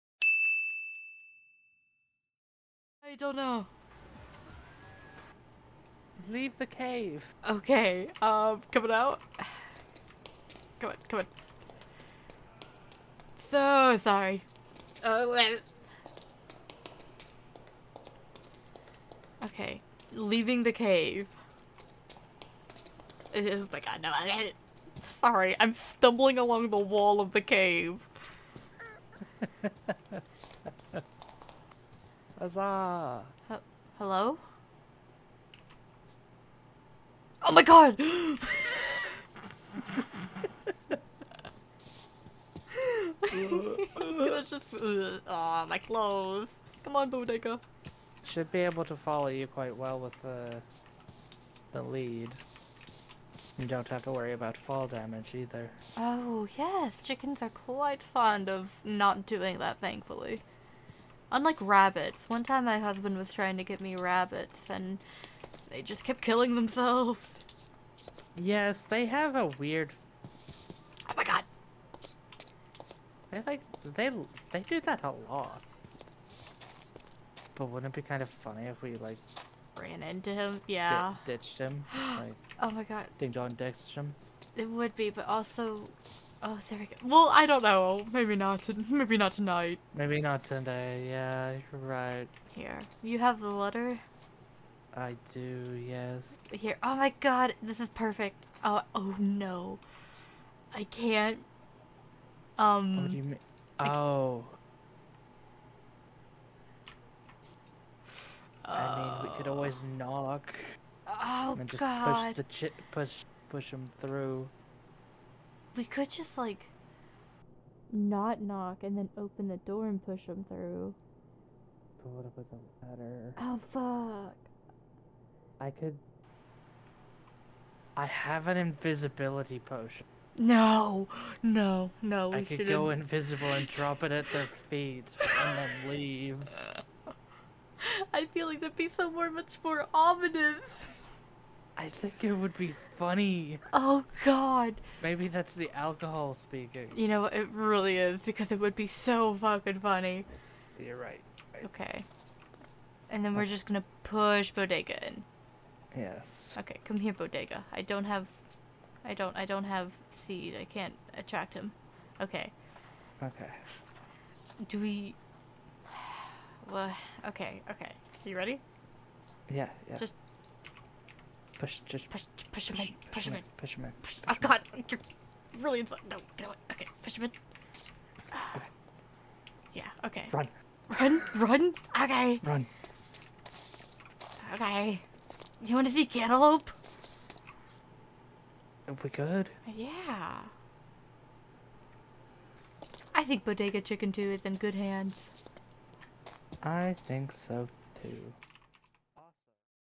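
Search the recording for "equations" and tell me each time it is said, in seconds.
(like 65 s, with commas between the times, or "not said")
not said.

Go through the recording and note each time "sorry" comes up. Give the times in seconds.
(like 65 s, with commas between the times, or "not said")
13 s, 25 s.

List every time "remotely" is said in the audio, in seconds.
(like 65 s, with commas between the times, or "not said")
not said.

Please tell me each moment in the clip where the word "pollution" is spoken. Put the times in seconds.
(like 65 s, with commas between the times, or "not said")
not said.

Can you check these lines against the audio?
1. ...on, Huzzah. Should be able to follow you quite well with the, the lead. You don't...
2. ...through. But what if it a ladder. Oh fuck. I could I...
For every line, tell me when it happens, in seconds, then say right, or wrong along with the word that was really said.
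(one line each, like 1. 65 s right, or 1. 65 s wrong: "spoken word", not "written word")
1. 46 s wrong: "Bodega", not "Huzzah"
2. 120 s right.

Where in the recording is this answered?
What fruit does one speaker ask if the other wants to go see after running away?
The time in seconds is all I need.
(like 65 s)
186 s.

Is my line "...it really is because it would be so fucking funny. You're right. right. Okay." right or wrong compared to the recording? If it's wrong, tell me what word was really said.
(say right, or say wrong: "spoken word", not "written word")
right.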